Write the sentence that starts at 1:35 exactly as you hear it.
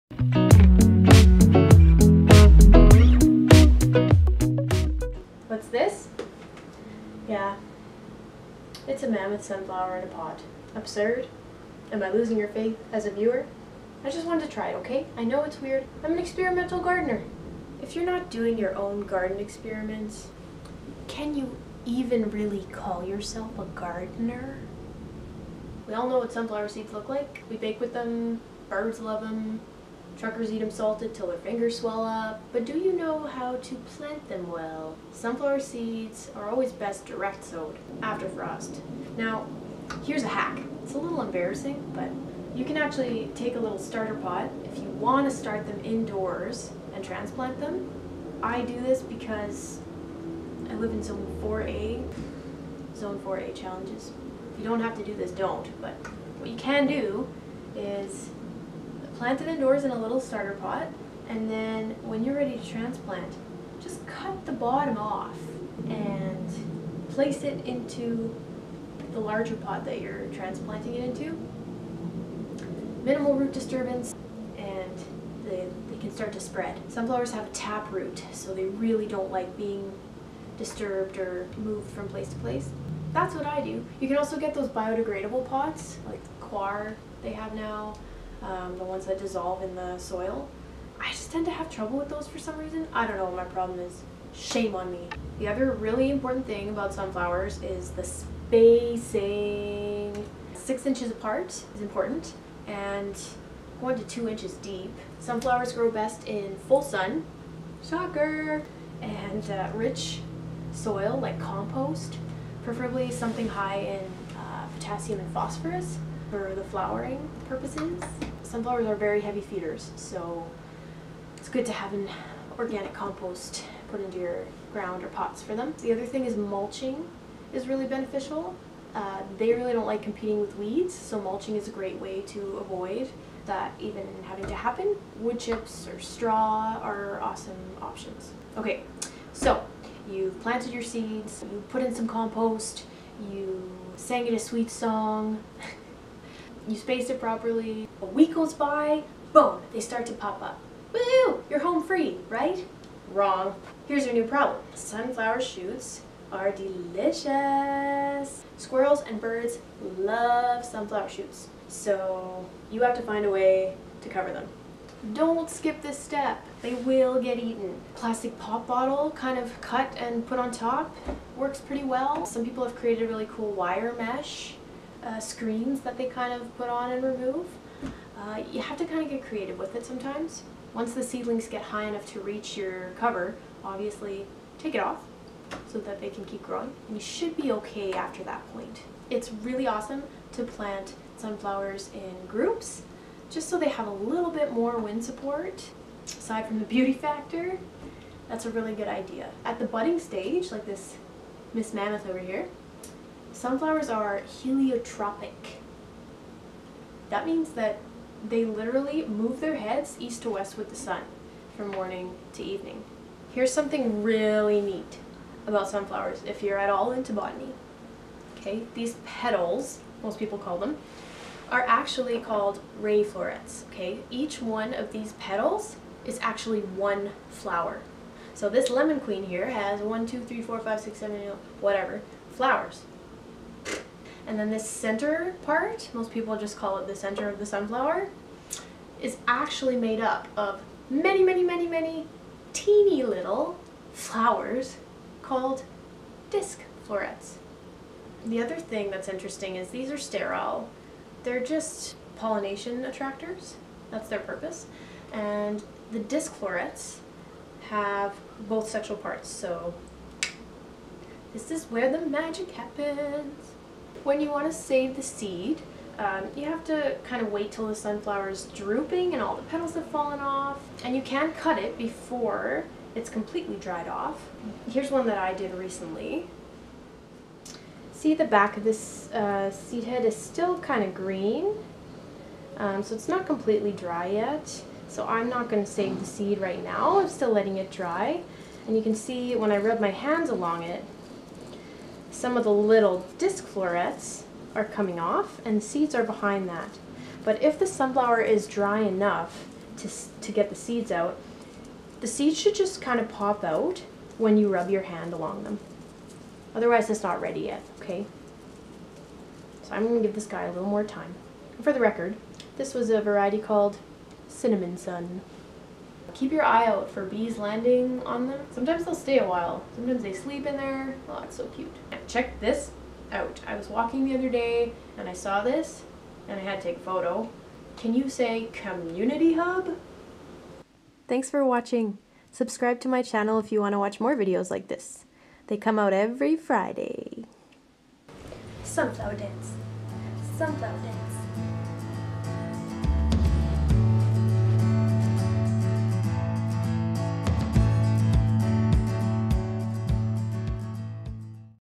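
The other really important thing about sunflowers is the spacing.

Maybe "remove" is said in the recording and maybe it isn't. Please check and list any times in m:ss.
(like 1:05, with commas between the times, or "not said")
2:57.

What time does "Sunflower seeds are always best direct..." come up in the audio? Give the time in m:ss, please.
0:35.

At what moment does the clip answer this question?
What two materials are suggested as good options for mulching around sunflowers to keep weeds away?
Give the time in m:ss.
2:15.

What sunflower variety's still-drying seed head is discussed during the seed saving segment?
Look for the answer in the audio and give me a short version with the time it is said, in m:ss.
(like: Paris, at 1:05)
Cinnamon Sun, at 5:14.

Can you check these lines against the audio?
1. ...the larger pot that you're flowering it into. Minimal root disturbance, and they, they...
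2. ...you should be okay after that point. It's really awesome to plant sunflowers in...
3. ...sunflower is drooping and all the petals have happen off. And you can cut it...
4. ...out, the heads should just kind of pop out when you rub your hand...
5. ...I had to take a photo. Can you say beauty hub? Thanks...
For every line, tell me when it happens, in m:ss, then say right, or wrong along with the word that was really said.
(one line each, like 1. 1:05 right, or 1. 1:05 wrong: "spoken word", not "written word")
1. 1:09 wrong: "transplanting", not "flowering"
2. 3:06 right
3. 4:27 wrong: "fallen", not "happen"
4. 5:00 wrong: "seeds", not "heads"
5. 5:26 wrong: "community", not "beauty".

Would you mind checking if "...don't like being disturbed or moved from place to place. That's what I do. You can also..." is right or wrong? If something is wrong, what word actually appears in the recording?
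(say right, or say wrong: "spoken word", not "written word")
right.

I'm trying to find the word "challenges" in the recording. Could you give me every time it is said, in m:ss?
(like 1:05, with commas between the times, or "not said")
0:53.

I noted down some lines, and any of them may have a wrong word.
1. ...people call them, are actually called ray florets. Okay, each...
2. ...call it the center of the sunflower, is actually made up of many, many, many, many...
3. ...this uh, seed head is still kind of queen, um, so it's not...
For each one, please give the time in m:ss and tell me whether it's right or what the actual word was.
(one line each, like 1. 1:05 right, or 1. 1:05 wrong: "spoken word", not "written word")
1. 3:40 right
2. 3:56 right
3. 4:38 wrong: "green", not "queen".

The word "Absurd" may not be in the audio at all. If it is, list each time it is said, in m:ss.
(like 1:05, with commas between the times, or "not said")
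0:10.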